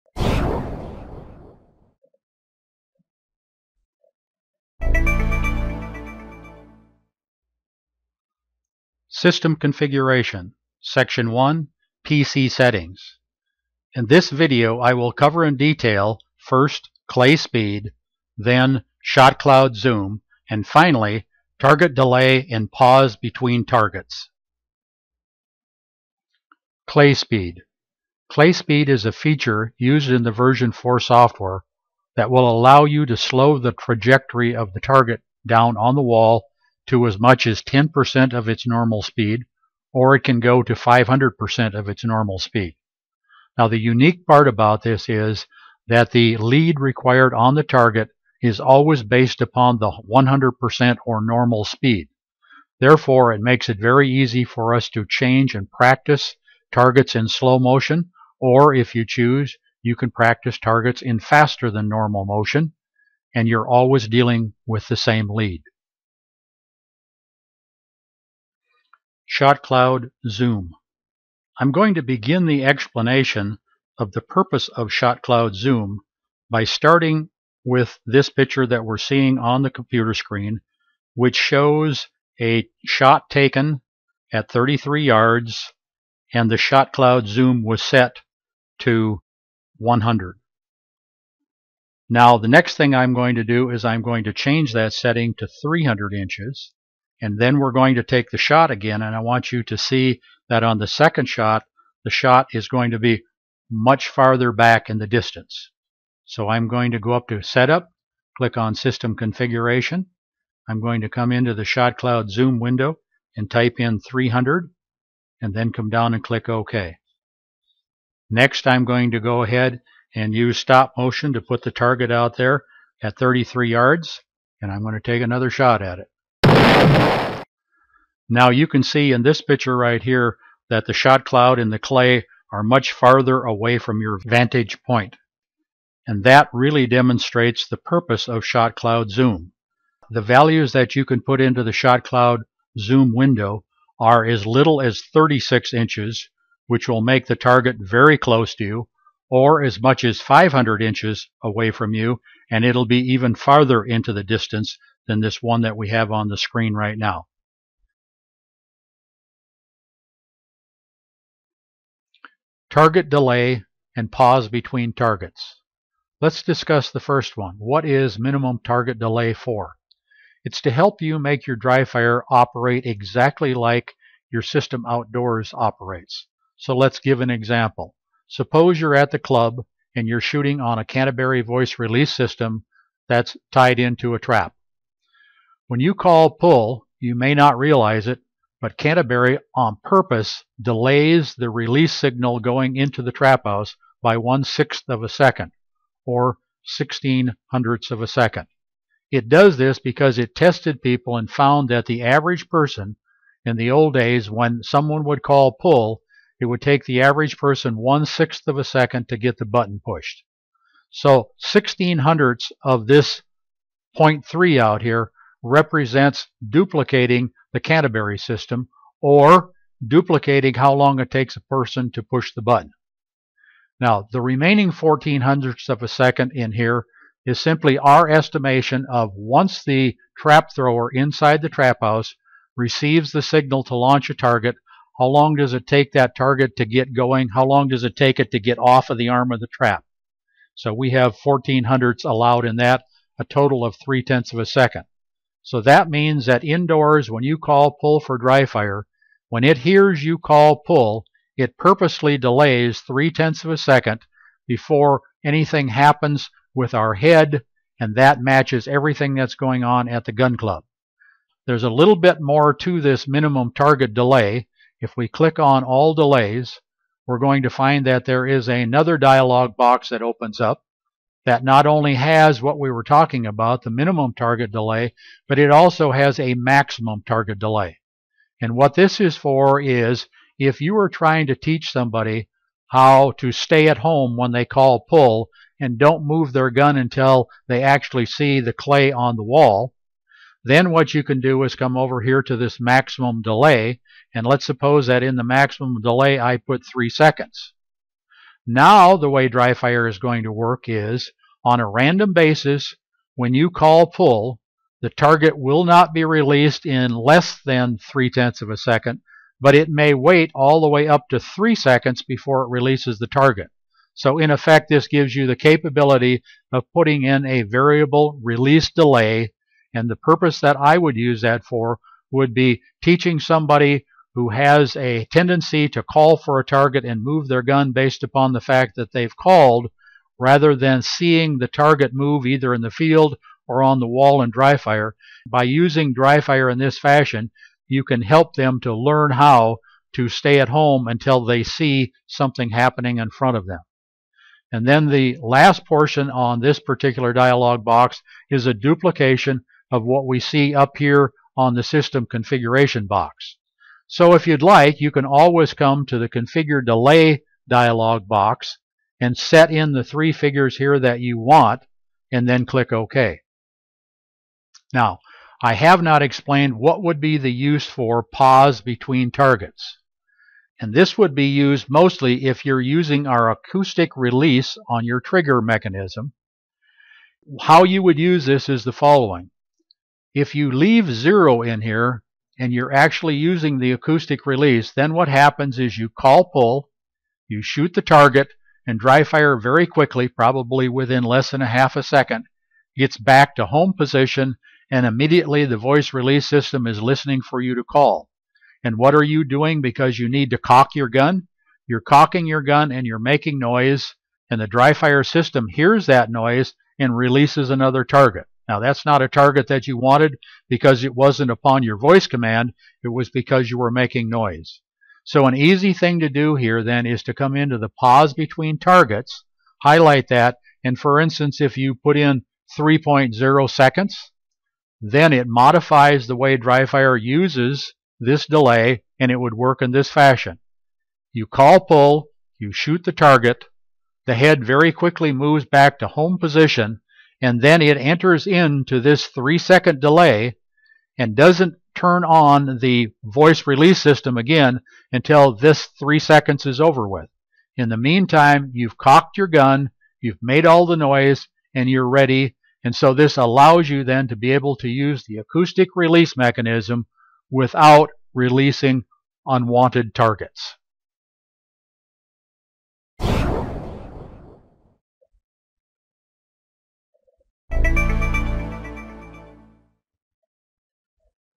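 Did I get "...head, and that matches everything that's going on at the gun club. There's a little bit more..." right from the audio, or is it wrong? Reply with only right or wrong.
right.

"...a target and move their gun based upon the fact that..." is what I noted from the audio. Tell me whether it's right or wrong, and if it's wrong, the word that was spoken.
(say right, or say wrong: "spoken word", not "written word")
right.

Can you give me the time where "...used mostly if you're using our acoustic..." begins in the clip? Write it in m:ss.
6:11.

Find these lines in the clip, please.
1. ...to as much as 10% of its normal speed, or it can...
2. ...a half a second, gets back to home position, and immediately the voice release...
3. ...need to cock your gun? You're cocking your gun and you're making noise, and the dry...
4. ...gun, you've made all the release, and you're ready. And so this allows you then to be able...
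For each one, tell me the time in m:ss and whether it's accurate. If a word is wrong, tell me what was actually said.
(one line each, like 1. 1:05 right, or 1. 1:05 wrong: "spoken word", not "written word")
1. 0:36 right
2. 6:31 right
3. 6:40 right
4. 7:29 wrong: "noise", not "release".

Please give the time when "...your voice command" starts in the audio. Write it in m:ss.
6:51.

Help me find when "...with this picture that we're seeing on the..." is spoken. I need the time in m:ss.
1:17.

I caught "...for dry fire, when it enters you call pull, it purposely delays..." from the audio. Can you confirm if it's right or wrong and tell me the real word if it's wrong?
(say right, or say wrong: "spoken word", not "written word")
wrong: "hears", not "enters".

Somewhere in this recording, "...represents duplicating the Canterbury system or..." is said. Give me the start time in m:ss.
3:35.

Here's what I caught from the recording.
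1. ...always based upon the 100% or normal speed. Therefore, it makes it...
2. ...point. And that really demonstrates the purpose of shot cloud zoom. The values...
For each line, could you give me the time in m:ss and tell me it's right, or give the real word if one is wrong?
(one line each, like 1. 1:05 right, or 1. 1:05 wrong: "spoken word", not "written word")
1. 0:48 right
2. 2:14 right.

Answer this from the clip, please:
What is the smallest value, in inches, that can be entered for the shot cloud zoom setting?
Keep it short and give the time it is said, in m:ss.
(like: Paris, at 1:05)
36 inches, at 2:25.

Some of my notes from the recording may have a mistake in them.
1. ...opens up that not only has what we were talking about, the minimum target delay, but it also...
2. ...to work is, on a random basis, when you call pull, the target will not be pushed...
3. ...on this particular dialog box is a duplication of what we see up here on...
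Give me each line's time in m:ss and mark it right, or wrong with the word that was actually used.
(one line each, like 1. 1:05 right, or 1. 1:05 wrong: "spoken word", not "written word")
1. 4:30 right
2. 5:00 wrong: "released", not "pushed"
3. 5:46 right.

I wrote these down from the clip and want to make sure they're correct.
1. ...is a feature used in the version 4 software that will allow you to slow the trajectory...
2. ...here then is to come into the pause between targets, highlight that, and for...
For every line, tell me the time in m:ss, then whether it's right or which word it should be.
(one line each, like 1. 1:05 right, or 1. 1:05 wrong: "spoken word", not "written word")
1. 0:28 right
2. 6:56 right.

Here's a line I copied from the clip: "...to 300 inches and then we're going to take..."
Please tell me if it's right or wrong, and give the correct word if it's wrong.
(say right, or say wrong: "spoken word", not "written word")
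right.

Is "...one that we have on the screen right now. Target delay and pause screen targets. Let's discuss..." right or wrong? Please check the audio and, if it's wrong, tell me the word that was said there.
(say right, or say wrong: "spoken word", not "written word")
wrong: "between", not "screen".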